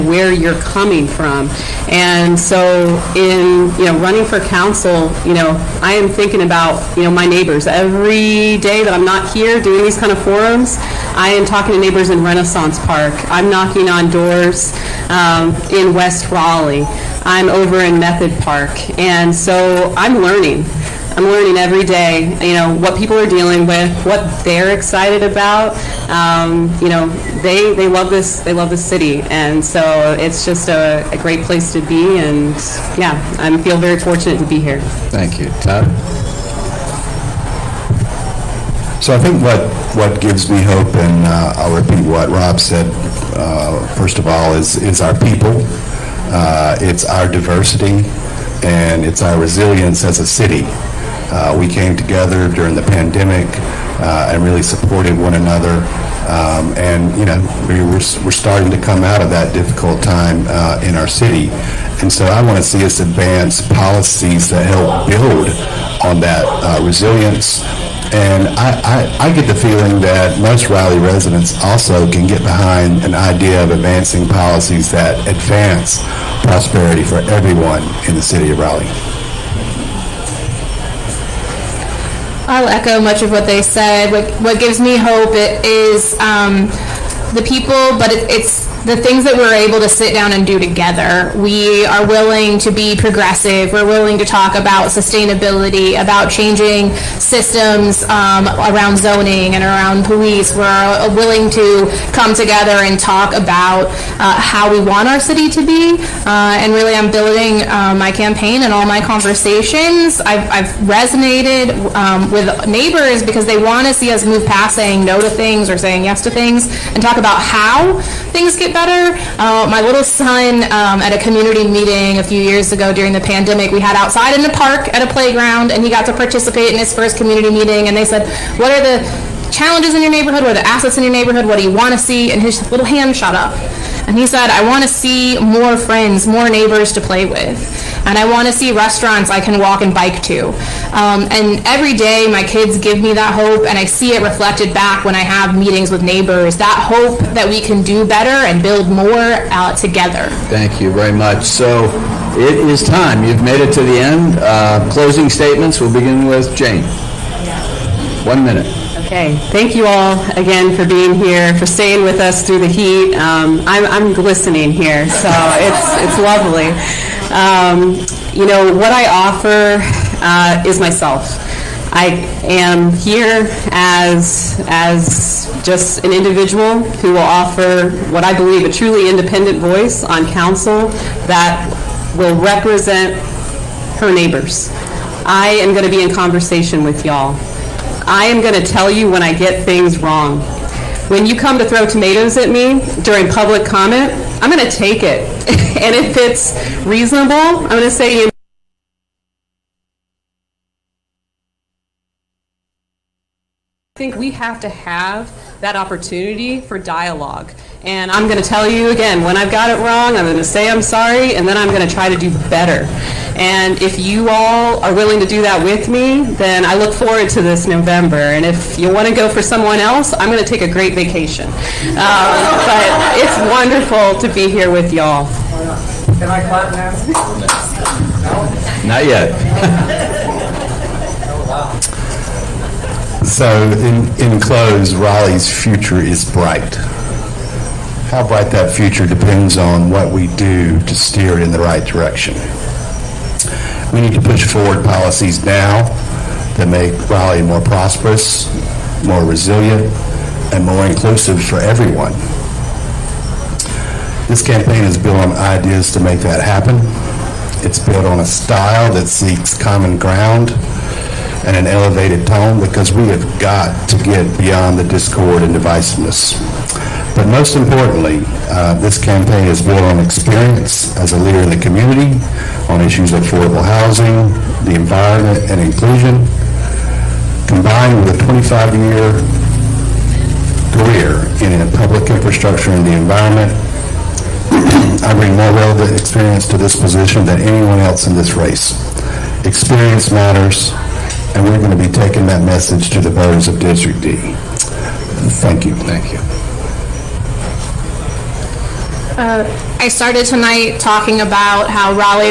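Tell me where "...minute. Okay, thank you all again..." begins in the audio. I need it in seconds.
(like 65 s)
158 s.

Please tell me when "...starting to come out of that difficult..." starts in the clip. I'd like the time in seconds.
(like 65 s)
58 s.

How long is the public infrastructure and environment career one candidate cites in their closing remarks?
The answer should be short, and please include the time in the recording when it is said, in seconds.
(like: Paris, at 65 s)
25 years, at 278 s.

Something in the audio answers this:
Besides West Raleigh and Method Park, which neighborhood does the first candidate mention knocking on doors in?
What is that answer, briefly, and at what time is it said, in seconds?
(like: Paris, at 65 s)
Renaissance Park, at 12 s.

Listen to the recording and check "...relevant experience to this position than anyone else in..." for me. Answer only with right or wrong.
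right.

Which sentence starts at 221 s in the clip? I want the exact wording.
Um, but it's wonderful to be here with y'all.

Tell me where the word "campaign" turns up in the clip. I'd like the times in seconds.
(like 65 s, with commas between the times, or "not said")
108 s, 254 s, 269 s.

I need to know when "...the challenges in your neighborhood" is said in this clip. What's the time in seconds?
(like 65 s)
128 s.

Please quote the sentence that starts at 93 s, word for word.
We're willing to talk about sustainability, about changing systems um, around zoning and around police.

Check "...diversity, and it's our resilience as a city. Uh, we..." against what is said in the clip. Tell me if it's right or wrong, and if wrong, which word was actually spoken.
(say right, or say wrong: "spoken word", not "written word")
right.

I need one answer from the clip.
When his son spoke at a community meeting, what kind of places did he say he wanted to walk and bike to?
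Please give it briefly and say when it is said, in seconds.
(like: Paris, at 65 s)
restaurants, at 138 s.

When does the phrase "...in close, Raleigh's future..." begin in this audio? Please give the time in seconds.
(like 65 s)
234 s.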